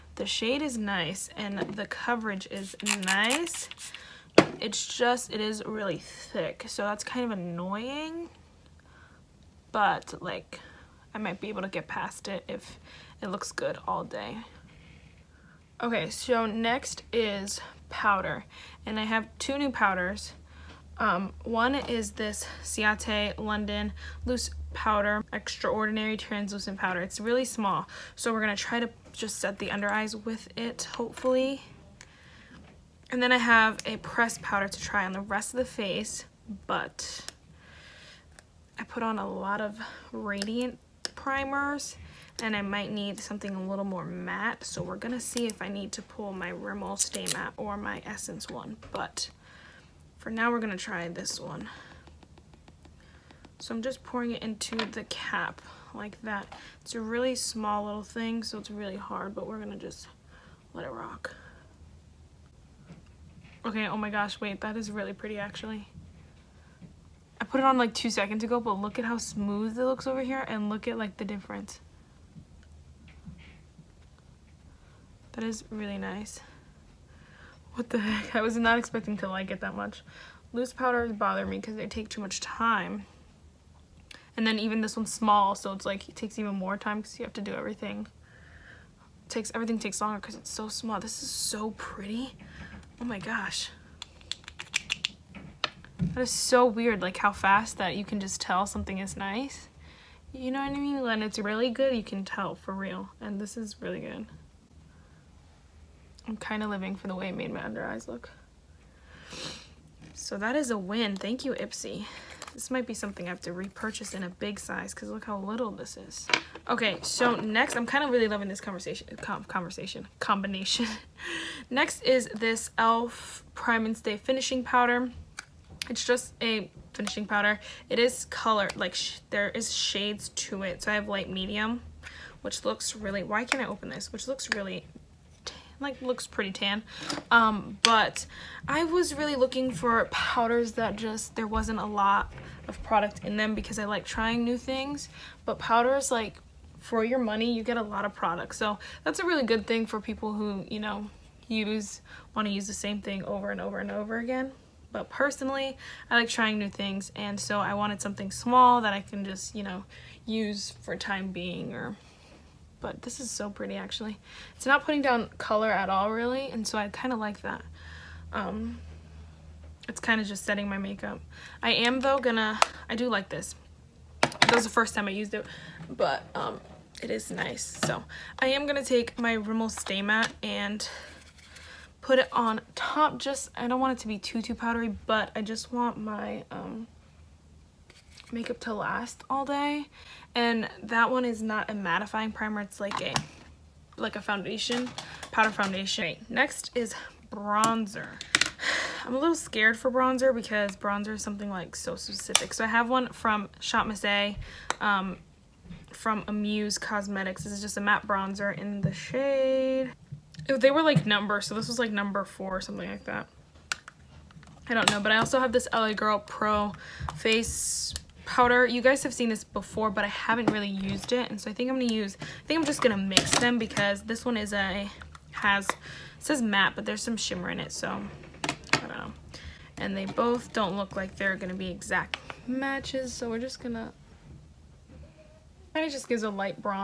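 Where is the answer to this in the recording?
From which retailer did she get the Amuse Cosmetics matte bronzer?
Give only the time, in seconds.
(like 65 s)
203 s.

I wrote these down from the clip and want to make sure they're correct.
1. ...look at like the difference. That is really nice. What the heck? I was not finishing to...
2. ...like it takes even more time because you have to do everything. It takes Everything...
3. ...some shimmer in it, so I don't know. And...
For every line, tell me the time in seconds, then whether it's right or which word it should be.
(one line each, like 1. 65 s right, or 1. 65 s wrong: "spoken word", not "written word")
1. 70 s wrong: "expecting", not "finishing"
2. 85 s right
3. 227 s right.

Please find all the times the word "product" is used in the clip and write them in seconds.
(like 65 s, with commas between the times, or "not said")
142 s, 148 s.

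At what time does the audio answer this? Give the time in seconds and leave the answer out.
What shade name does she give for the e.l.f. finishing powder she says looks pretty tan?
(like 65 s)
131 s.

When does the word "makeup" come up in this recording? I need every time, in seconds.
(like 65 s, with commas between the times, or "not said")
170 s, 188 s.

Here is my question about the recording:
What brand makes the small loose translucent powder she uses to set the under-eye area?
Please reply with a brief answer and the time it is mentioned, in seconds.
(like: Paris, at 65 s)
Ciate London, at 22 s.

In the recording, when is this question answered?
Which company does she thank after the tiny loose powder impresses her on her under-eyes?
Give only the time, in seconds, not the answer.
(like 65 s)
111 s.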